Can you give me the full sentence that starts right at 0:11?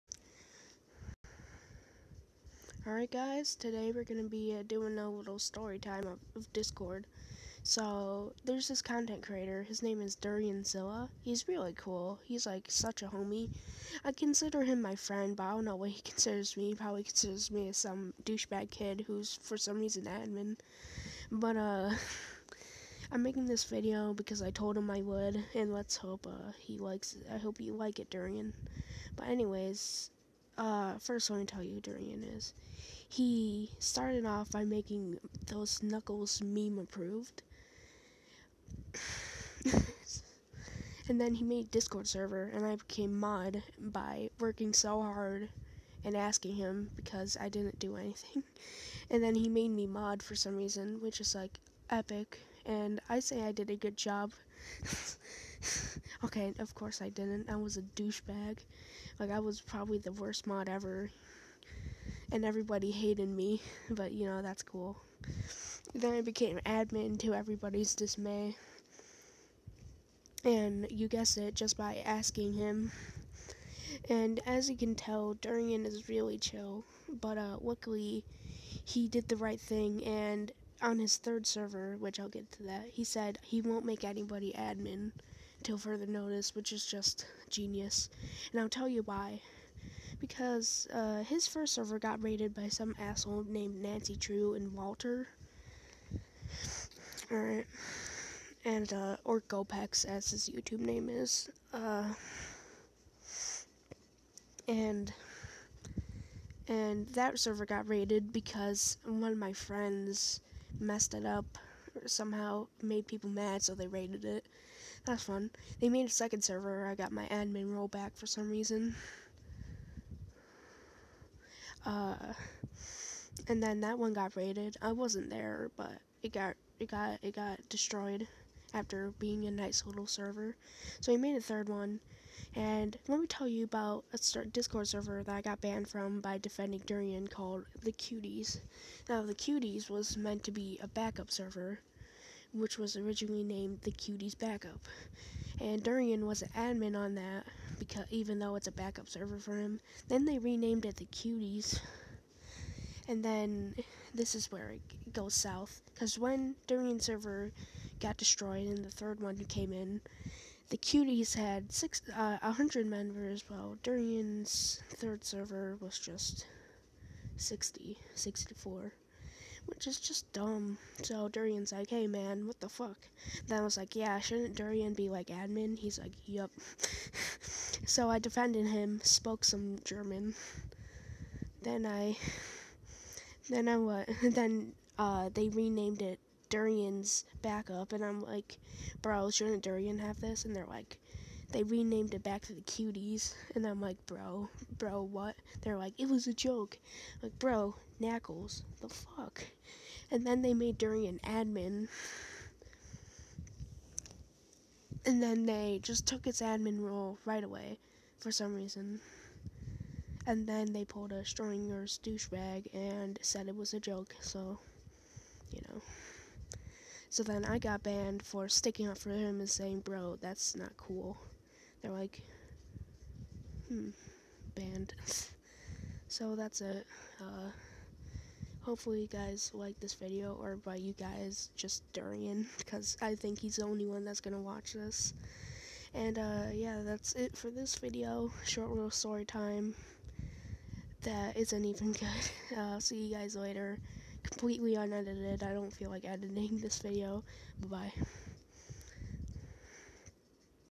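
He's really cool, he's like such a homie.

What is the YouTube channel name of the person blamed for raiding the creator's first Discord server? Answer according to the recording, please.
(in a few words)
Gopex.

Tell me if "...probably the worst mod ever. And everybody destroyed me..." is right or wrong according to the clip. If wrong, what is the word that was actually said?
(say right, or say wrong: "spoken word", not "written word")
wrong: "hated", not "destroyed".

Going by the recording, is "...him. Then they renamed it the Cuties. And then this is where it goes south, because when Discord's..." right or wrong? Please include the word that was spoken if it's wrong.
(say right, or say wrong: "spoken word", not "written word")
wrong: "Durian", not "Discord".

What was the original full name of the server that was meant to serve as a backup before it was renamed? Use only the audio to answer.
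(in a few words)
the Cuties Backup.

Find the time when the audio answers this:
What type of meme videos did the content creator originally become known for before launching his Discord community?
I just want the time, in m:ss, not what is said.
0:35.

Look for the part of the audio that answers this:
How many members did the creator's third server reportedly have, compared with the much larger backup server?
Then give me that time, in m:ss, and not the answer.
2:48.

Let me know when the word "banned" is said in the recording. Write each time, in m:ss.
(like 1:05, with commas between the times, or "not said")
2:15, 3:37, 3:44.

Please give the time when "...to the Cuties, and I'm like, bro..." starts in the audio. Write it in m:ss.
3:12.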